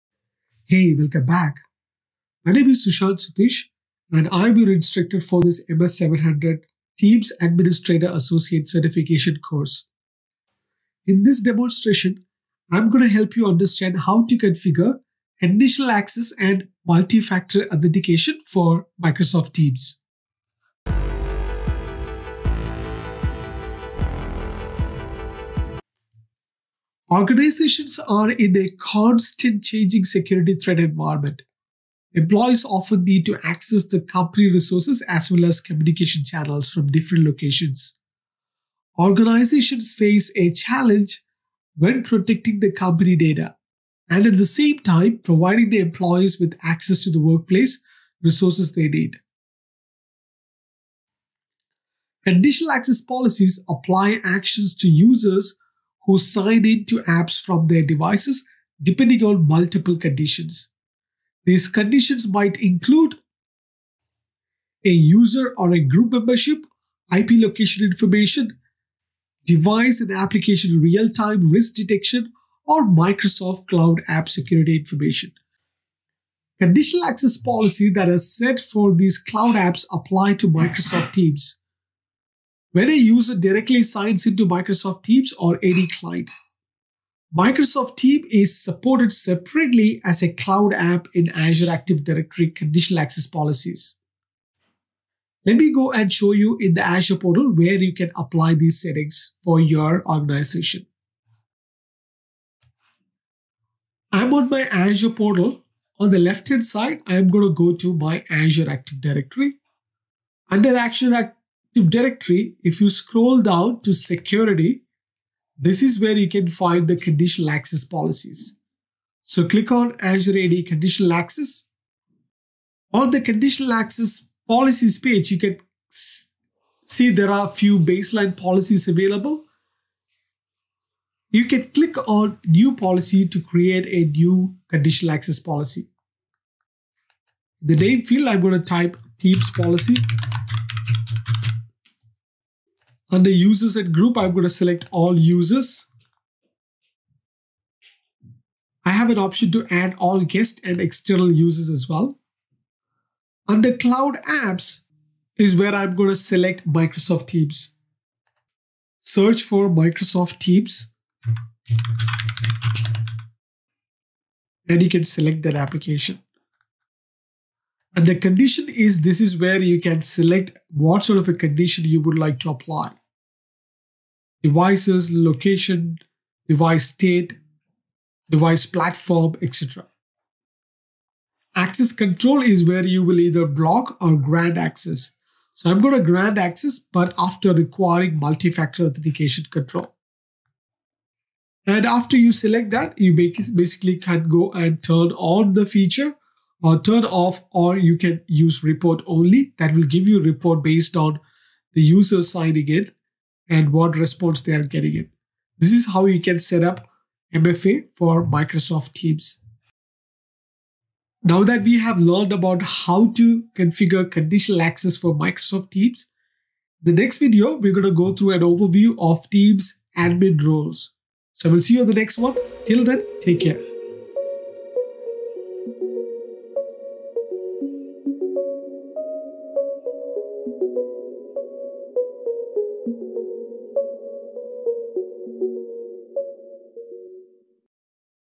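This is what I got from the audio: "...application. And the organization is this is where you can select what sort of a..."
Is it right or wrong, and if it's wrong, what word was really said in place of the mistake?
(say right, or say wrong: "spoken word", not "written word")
wrong: "condition", not "organization".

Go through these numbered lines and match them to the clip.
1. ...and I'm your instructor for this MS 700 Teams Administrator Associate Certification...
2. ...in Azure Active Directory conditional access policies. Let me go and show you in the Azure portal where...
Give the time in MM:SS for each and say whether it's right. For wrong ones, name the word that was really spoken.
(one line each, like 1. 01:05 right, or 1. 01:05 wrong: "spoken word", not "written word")
1. 00:04 right
2. 01:31 right.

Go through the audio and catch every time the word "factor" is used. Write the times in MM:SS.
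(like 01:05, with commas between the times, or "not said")
00:16, 03:08.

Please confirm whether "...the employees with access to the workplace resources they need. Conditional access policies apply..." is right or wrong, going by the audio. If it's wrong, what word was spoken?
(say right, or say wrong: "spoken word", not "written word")
right.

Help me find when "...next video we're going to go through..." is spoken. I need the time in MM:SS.
03:36.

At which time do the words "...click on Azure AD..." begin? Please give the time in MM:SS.
01:59.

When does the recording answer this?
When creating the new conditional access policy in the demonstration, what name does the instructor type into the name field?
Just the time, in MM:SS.
02:19.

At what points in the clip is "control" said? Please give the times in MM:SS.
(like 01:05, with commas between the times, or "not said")
03:01, 03:09.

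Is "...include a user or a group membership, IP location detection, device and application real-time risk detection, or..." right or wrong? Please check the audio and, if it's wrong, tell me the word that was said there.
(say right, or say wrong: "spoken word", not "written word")
wrong: "information", not "detection".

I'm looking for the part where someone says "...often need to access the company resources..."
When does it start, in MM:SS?
00:32.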